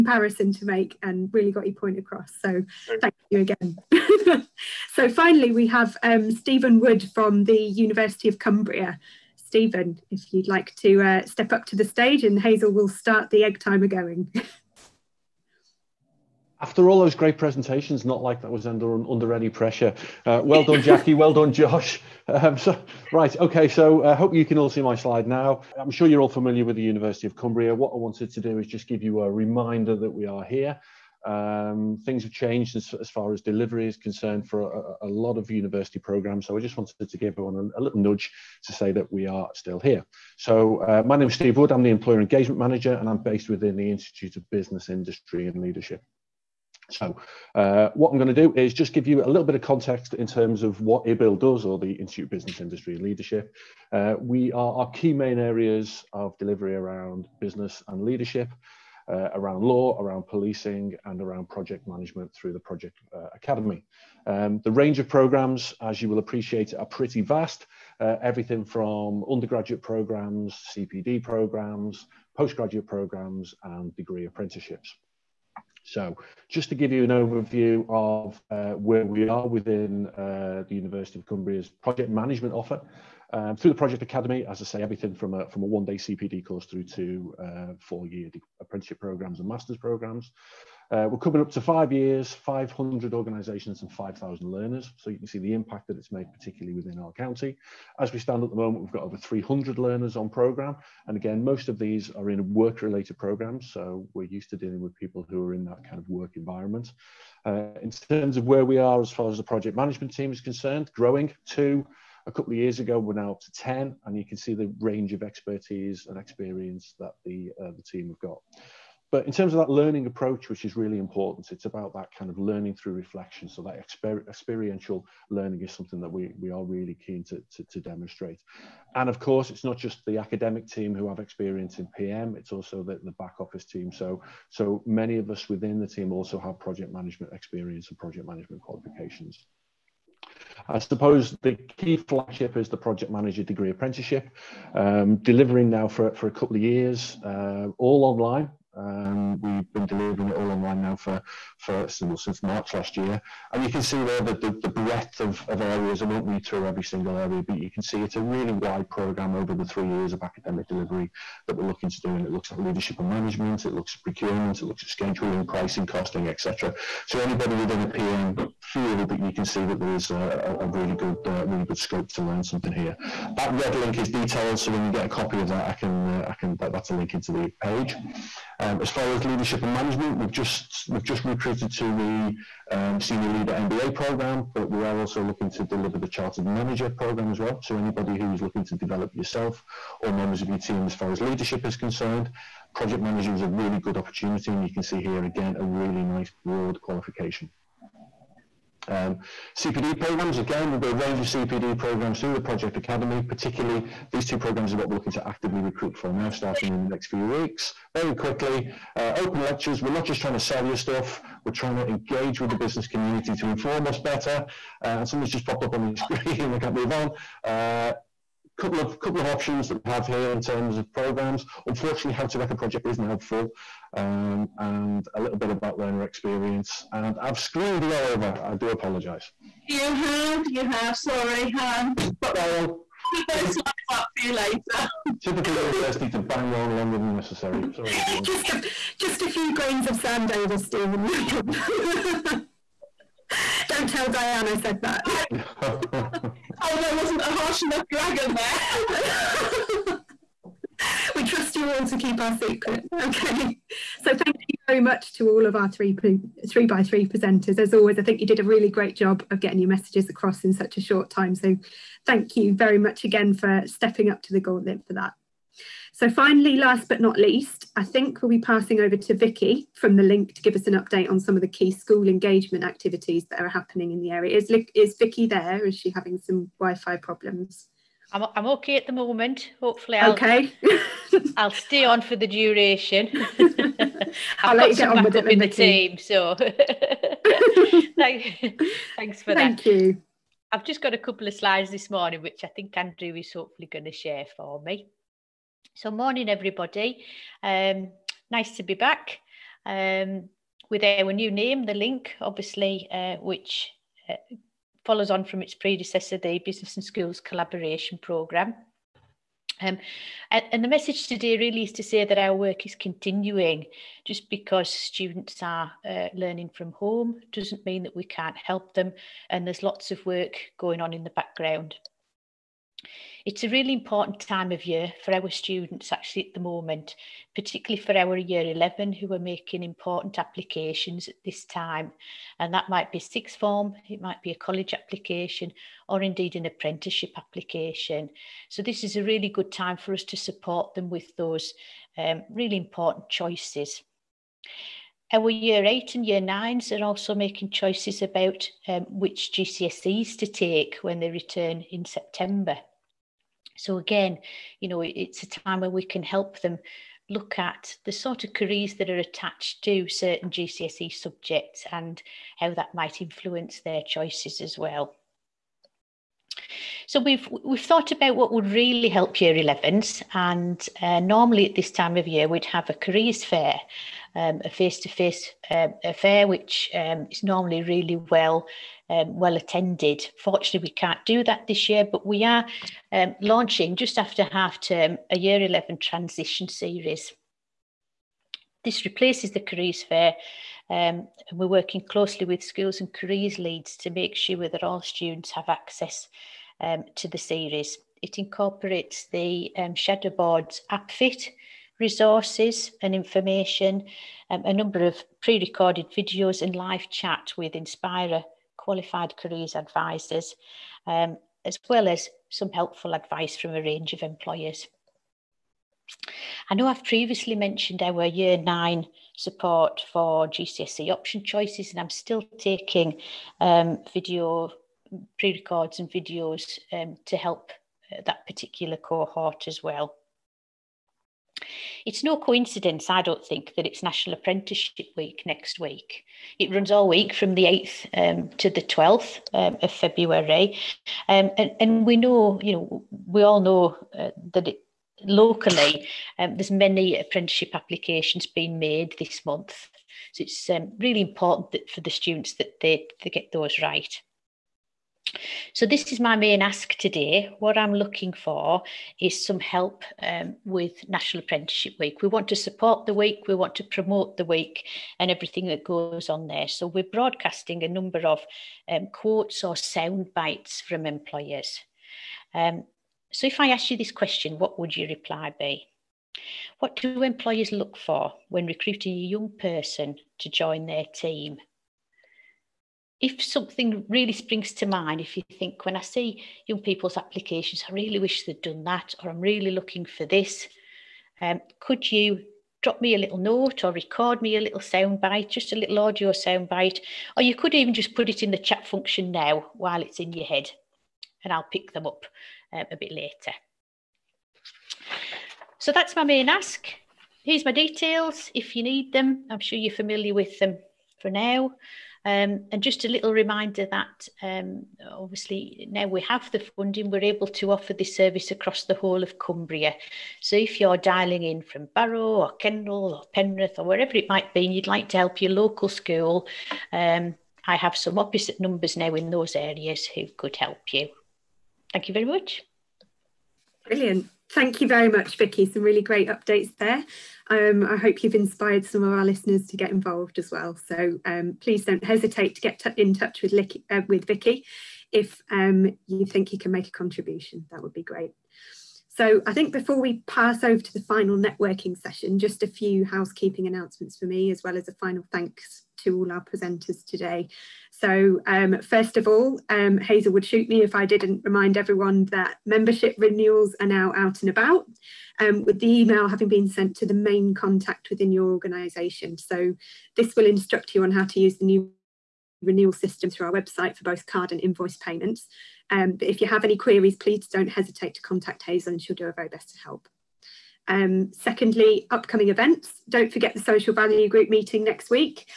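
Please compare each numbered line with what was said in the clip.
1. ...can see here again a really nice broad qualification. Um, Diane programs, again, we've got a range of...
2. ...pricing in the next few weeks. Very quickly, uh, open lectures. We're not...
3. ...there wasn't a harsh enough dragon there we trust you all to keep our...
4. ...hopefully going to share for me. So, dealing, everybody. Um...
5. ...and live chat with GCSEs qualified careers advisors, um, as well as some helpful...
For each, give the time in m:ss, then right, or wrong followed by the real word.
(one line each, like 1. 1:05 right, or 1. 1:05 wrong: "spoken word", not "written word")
1. 3:14 wrong: "CPD", not "Diane"
2. 3:26 wrong: "starting", not "pricing"
3. 4:06 right
4. 4:53 wrong: "morning", not "dealing"
5. 6:46 wrong: "Inspira", not "GCSEs".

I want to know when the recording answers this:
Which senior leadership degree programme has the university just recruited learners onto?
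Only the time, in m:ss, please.
3:02.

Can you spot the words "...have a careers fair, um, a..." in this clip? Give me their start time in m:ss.
6:12.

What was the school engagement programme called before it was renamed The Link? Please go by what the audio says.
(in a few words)
Business and Schools Collaboration Programme.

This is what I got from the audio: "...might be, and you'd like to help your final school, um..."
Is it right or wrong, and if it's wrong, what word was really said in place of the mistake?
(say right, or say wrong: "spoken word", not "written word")
wrong: "local", not "final".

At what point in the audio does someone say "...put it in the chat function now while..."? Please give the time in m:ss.
8:17.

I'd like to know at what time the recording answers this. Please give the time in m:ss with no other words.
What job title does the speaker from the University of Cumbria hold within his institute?
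0:41.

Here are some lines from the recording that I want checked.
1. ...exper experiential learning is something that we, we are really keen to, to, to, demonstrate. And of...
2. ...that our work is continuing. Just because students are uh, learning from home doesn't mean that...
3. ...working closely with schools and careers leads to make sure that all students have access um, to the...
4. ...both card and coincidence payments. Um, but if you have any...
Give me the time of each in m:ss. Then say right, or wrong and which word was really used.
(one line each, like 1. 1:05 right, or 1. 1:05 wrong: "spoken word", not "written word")
1. 2:03 right
2. 5:12 right
3. 6:31 right
4. 9:33 wrong: "invoice", not "coincidence".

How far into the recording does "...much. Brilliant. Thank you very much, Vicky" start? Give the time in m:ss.
8:52.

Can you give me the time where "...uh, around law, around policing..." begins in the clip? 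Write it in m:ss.
0:59.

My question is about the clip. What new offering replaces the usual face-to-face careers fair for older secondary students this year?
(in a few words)
year 11 transition series.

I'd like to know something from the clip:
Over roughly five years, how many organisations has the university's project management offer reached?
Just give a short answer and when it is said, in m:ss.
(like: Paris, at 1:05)
500, at 1:32.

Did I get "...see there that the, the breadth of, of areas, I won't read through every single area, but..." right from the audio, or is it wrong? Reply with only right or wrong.
right.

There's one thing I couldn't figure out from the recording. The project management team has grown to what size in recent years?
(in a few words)
10.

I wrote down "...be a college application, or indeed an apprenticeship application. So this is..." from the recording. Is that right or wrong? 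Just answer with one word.
right.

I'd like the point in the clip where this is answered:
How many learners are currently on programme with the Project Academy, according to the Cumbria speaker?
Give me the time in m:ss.
1:39.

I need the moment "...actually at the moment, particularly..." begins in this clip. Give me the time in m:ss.
5:25.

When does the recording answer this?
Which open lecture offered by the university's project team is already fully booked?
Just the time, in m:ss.
3:42.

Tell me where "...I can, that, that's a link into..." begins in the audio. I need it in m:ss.
2:56.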